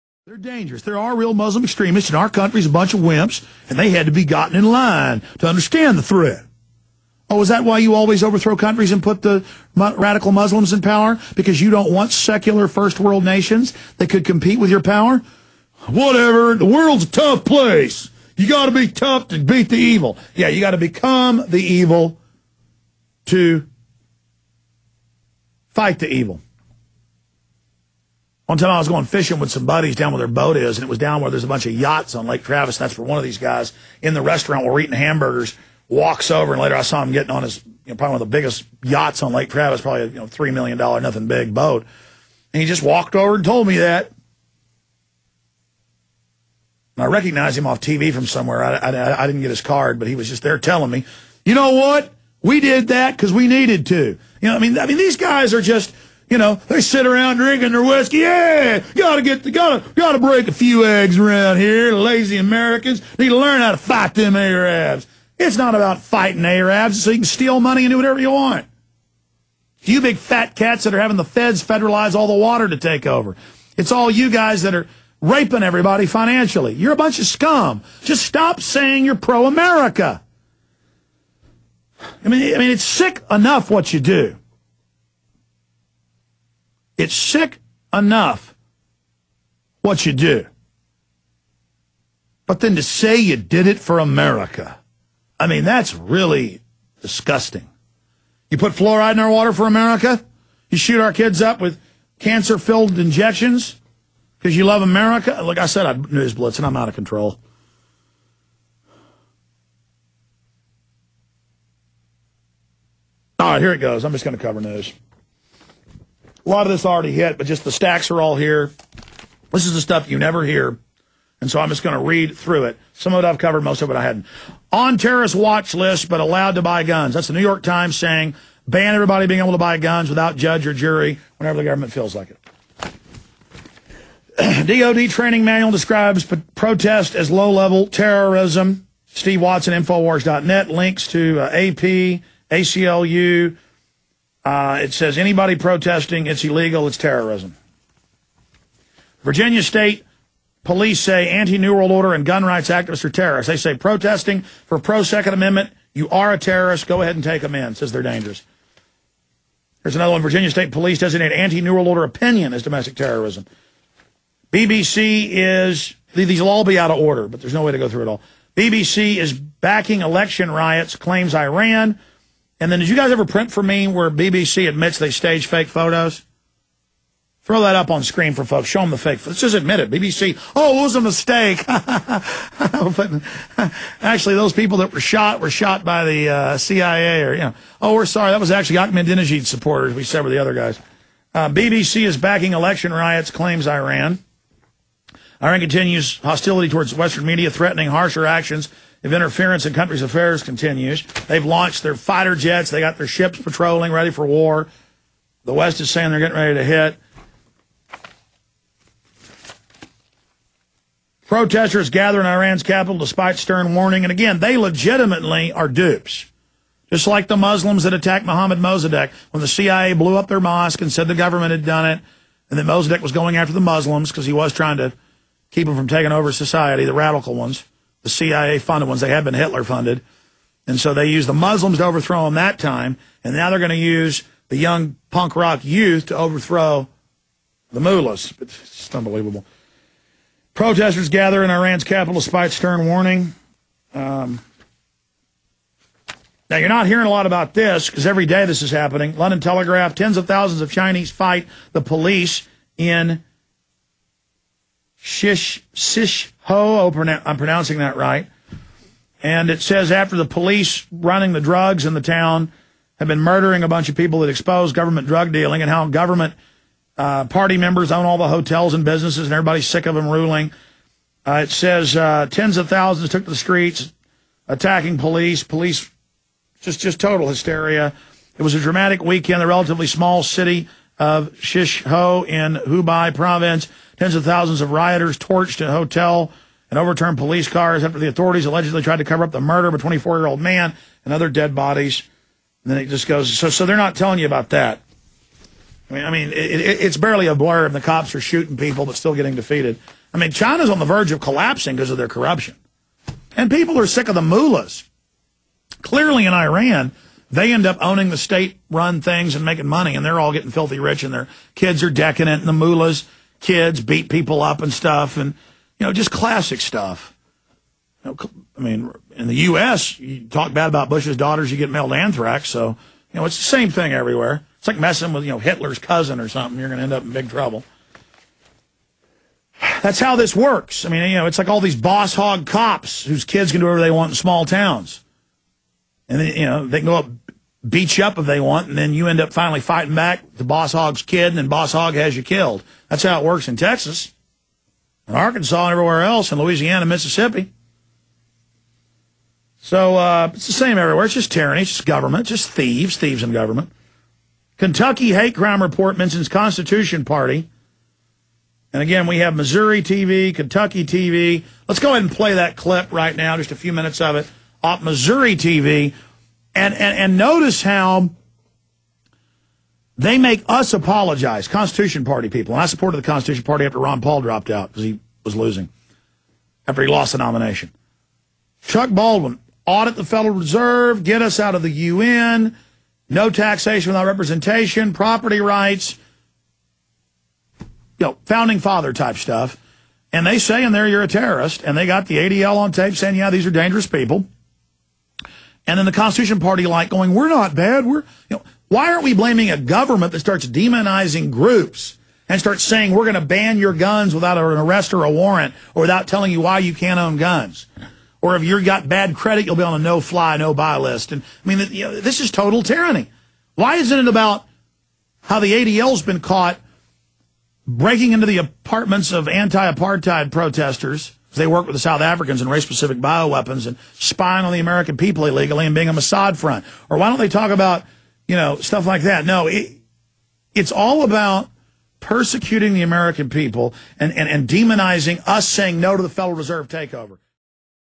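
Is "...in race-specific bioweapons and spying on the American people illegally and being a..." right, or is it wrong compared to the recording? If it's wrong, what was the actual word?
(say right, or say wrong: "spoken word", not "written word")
right.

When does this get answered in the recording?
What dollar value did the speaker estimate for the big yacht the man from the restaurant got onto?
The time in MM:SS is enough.
00:40.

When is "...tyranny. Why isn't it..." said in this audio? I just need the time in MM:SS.
06:52.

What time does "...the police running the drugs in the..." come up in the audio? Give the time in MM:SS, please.
04:20.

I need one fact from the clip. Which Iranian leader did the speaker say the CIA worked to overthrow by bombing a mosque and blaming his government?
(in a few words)
Mohammed Mossadegh.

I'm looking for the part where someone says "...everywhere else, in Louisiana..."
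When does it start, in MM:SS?
05:45.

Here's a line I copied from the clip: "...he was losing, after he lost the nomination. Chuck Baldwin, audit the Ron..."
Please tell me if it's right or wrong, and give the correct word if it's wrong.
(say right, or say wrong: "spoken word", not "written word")
wrong: "Federal", not "Ron".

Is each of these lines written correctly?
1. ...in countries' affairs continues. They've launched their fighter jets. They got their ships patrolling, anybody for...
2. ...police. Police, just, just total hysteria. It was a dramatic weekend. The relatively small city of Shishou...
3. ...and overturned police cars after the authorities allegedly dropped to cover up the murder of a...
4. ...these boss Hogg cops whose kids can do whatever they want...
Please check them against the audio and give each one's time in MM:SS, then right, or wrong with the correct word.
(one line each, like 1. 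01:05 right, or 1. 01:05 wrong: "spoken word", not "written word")
1. 03:19 wrong: "ready", not "anybody"
2. 04:34 right
3. 04:46 wrong: "tried", not "dropped"
4. 05:31 right.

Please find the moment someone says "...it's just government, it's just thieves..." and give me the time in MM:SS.
05:51.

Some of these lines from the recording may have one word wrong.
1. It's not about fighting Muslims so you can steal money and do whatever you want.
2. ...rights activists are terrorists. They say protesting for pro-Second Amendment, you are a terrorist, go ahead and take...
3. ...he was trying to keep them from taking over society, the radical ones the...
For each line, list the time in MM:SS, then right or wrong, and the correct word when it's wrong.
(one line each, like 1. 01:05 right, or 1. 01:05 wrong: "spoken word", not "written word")
1. 01:05 wrong: "Arabs", not "Muslims"
2. 02:32 right
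3. 03:44 right.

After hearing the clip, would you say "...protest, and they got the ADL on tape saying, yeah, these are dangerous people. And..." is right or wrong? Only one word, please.
wrong.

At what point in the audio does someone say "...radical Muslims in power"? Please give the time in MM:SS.
00:09.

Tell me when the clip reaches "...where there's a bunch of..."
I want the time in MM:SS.
00:31.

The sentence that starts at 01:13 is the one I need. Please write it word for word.
It's all you guys that are raping everybody financially.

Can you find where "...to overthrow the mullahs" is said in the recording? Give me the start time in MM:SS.
03:56.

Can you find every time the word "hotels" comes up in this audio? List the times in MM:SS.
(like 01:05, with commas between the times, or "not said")
04:28, 04:45.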